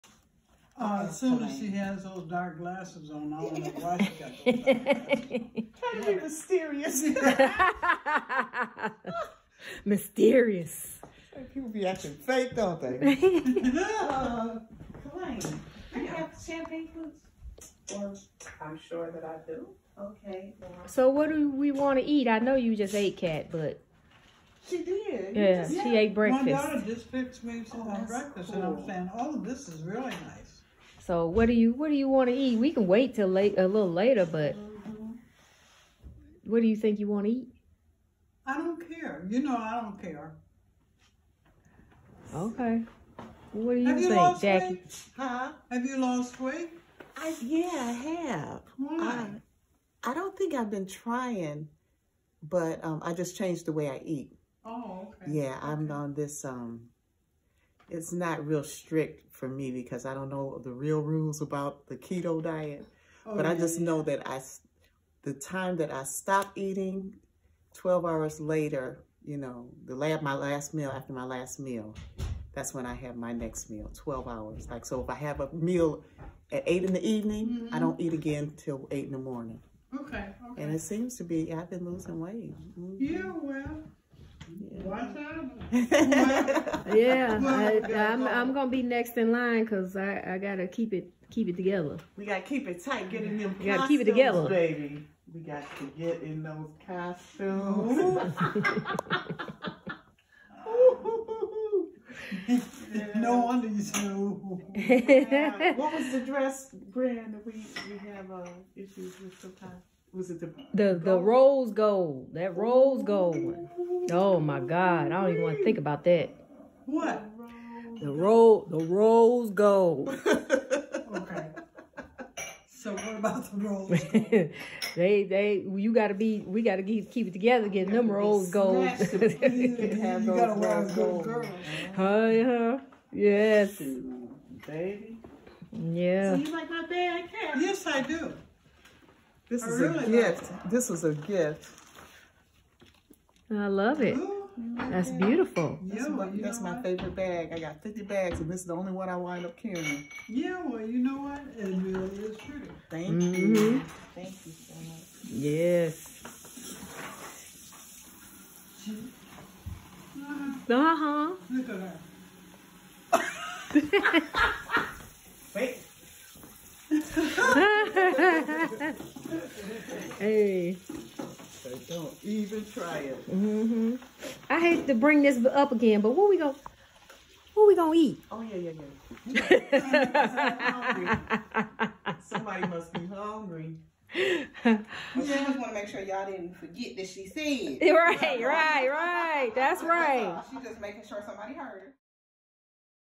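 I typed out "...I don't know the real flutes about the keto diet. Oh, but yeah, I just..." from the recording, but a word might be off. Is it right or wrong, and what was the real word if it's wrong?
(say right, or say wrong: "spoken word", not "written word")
wrong: "rules", not "flutes".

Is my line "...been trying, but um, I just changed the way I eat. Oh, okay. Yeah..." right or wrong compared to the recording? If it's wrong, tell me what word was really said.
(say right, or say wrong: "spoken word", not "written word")
right.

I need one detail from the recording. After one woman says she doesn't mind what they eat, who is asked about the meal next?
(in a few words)
Jackie.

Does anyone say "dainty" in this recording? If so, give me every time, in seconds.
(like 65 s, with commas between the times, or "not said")
not said.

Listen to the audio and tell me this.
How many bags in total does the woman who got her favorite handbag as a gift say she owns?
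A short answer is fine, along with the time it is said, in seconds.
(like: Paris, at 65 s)
50, at 147 s.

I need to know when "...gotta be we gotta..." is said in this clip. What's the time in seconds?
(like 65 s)
125 s.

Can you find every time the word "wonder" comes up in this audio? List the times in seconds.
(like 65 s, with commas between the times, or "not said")
3 s, 103 s.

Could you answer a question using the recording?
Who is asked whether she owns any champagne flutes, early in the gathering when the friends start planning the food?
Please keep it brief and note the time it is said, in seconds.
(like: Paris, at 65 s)
Colleen, at 15 s.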